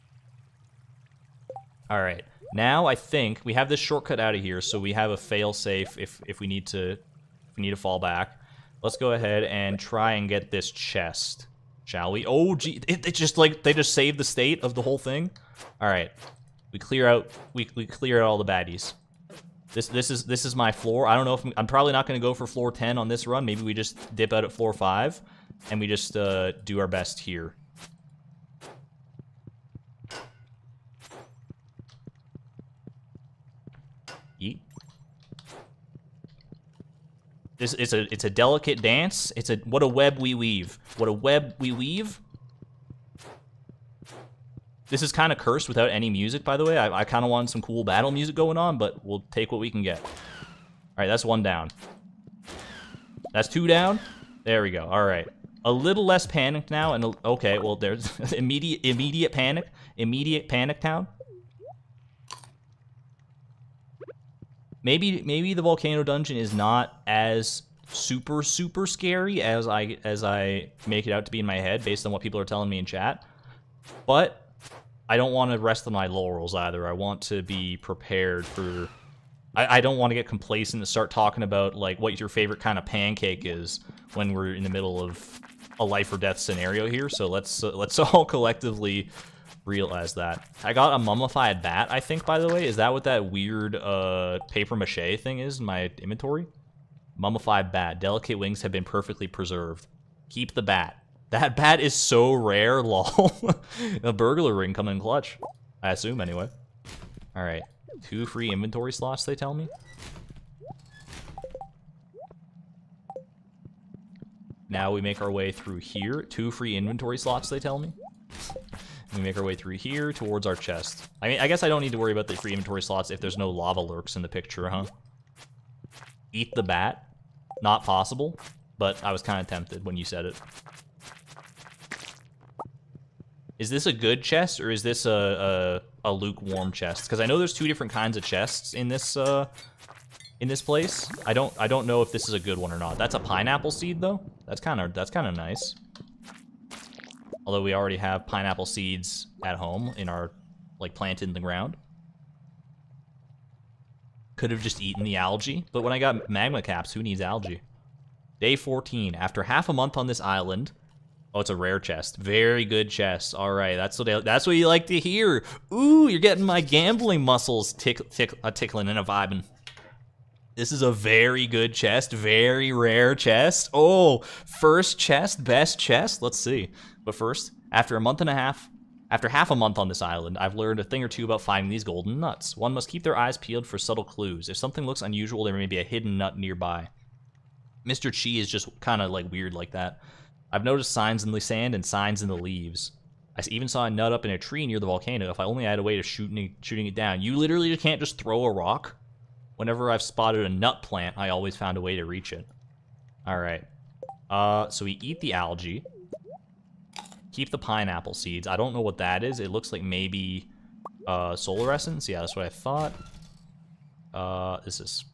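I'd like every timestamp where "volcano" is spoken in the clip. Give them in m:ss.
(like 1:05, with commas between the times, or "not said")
1:05, 3:14.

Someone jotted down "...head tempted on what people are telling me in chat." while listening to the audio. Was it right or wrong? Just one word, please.
wrong.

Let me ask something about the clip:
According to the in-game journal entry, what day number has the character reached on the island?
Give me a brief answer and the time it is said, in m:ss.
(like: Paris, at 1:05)
14, at 2:38.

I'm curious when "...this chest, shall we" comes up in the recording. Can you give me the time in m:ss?
0:10.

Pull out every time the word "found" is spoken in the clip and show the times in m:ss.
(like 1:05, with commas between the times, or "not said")
3:21.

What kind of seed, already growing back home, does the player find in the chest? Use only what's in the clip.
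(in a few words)
Pineapple seed.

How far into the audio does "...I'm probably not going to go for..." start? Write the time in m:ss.
0:21.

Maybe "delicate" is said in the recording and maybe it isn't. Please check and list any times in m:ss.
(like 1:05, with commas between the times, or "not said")
0:38, 1:37.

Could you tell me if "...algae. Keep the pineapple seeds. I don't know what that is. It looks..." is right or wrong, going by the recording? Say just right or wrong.
right.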